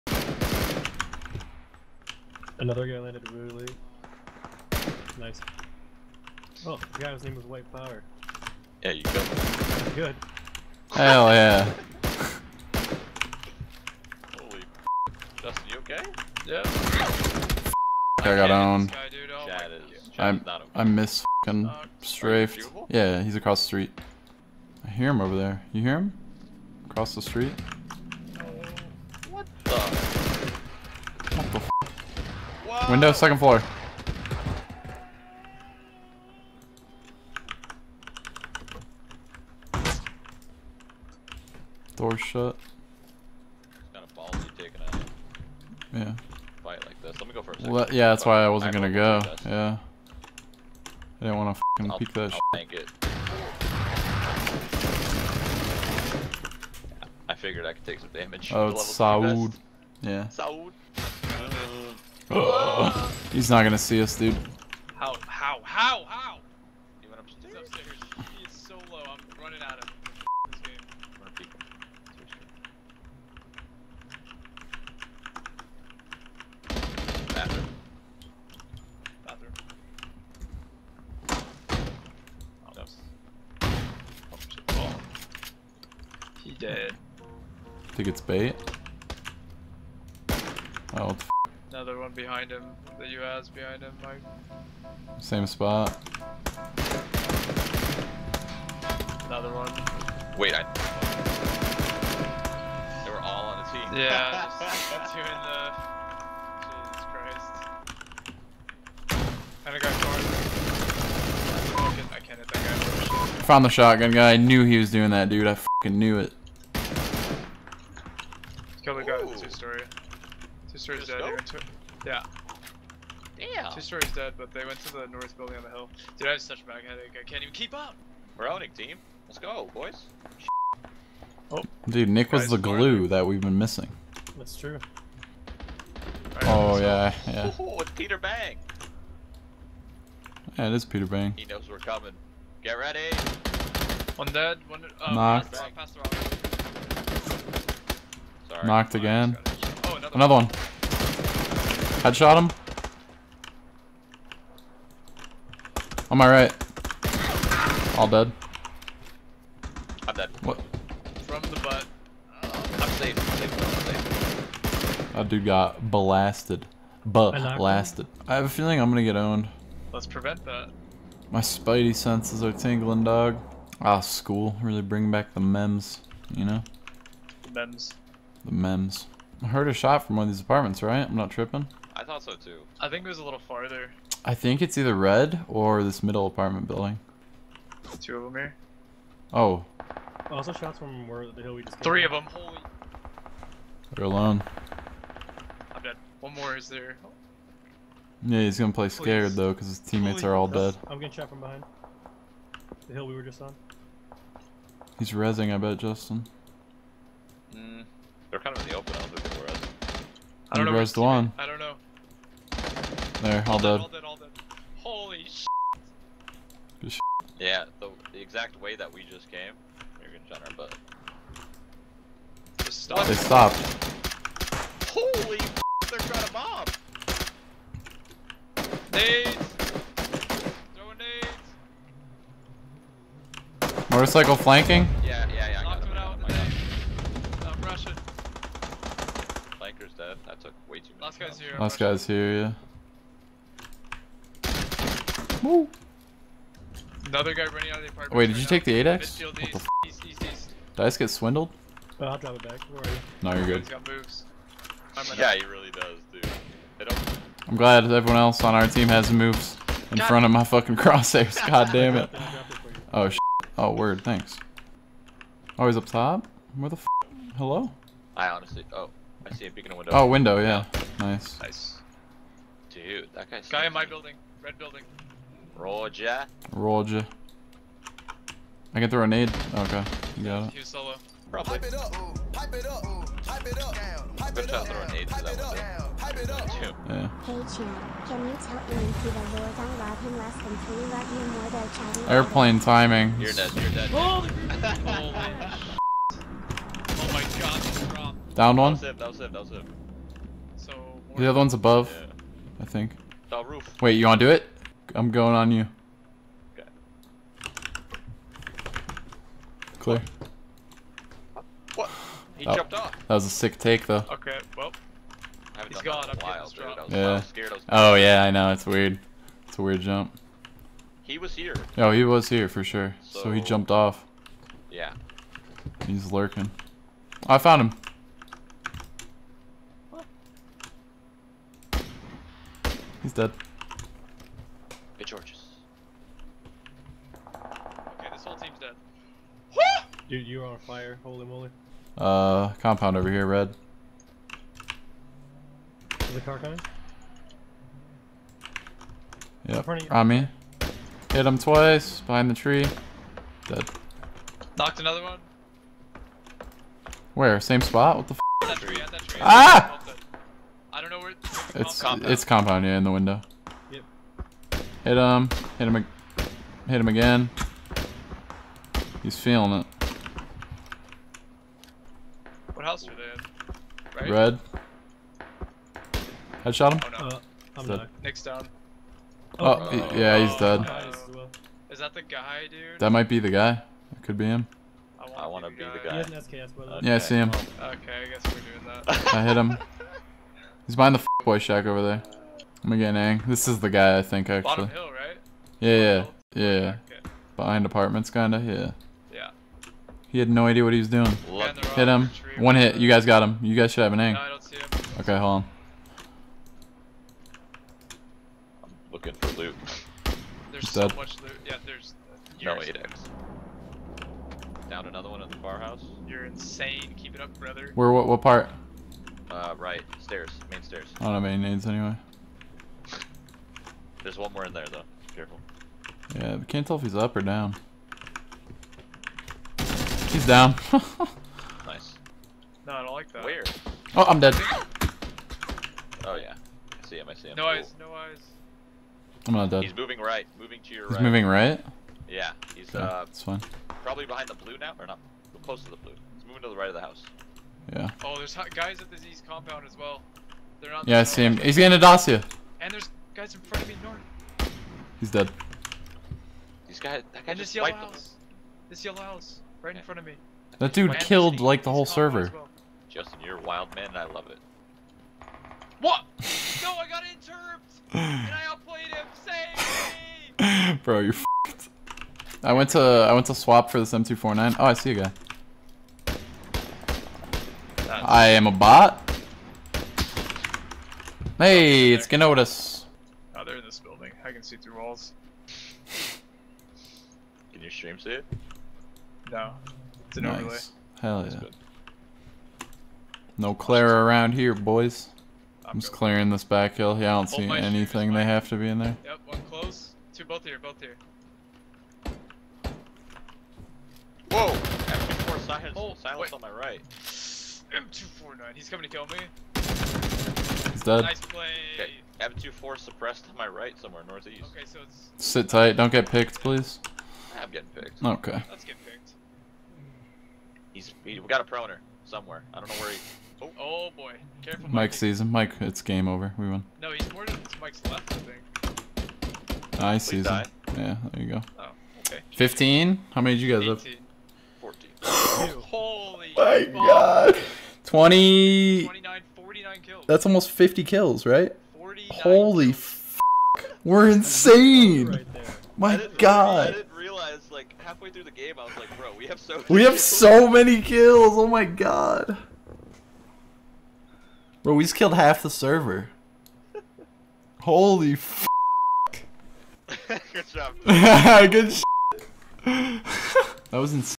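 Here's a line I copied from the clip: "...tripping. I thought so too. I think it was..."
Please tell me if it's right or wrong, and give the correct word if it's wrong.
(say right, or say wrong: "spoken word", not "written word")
right.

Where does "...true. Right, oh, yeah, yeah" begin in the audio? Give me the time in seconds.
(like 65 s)
134 s.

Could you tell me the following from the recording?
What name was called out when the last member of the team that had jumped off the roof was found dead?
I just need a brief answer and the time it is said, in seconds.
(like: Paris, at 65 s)
Georges, at 335 s.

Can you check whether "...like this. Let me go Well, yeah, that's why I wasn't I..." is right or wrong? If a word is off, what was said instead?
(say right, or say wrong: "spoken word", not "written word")
right.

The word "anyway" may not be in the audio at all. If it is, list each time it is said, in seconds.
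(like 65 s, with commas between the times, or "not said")
421 s.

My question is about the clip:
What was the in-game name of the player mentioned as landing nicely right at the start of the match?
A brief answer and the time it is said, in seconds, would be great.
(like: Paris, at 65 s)
White Power, at 7 s.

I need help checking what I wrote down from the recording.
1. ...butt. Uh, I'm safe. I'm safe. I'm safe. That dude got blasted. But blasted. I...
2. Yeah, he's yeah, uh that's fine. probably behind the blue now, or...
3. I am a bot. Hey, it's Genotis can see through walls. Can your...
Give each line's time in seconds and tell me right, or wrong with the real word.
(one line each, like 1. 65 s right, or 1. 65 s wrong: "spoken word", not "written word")
1. 161 s right
2. 442 s right
3. 478 s right.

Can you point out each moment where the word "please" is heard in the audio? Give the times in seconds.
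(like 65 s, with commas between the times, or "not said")
199 s, 516 s.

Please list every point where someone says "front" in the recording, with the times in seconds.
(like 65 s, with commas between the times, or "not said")
260 s, 453 s, 459 s.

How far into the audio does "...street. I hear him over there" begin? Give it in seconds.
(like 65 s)
23 s.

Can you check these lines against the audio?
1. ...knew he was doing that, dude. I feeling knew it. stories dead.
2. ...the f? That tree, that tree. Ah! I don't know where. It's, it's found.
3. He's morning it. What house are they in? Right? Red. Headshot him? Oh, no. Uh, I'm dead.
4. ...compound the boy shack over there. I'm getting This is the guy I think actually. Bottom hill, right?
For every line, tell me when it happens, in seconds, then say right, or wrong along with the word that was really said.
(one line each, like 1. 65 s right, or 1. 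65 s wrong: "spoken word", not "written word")
1. 114 s wrong: "fucking", not "feeling"
2. 358 s wrong: "compound", not "found"
3. 369 s wrong: "feeling", not "morning"
4. 390 s wrong: "behind", not "compound".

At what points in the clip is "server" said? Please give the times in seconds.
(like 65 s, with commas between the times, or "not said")
461 s, 555 s.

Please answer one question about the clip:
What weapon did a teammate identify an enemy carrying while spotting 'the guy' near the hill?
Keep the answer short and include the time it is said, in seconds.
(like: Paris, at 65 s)
SKS, at 386 s.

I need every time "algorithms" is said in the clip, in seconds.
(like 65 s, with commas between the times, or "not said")
not said.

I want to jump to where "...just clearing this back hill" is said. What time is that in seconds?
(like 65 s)
495 s.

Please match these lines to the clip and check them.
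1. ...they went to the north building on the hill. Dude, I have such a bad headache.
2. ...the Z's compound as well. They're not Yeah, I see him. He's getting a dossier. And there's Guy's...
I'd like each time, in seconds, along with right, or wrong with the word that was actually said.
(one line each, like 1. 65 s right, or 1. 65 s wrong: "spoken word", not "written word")
1. 124 s right
2. 448 s right.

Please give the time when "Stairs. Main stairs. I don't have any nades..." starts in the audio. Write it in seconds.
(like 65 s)
419 s.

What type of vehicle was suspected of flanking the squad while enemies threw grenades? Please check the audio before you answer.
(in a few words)
Motorcycle.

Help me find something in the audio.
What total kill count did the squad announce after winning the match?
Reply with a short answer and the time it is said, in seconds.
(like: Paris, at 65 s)
49, at 539 s.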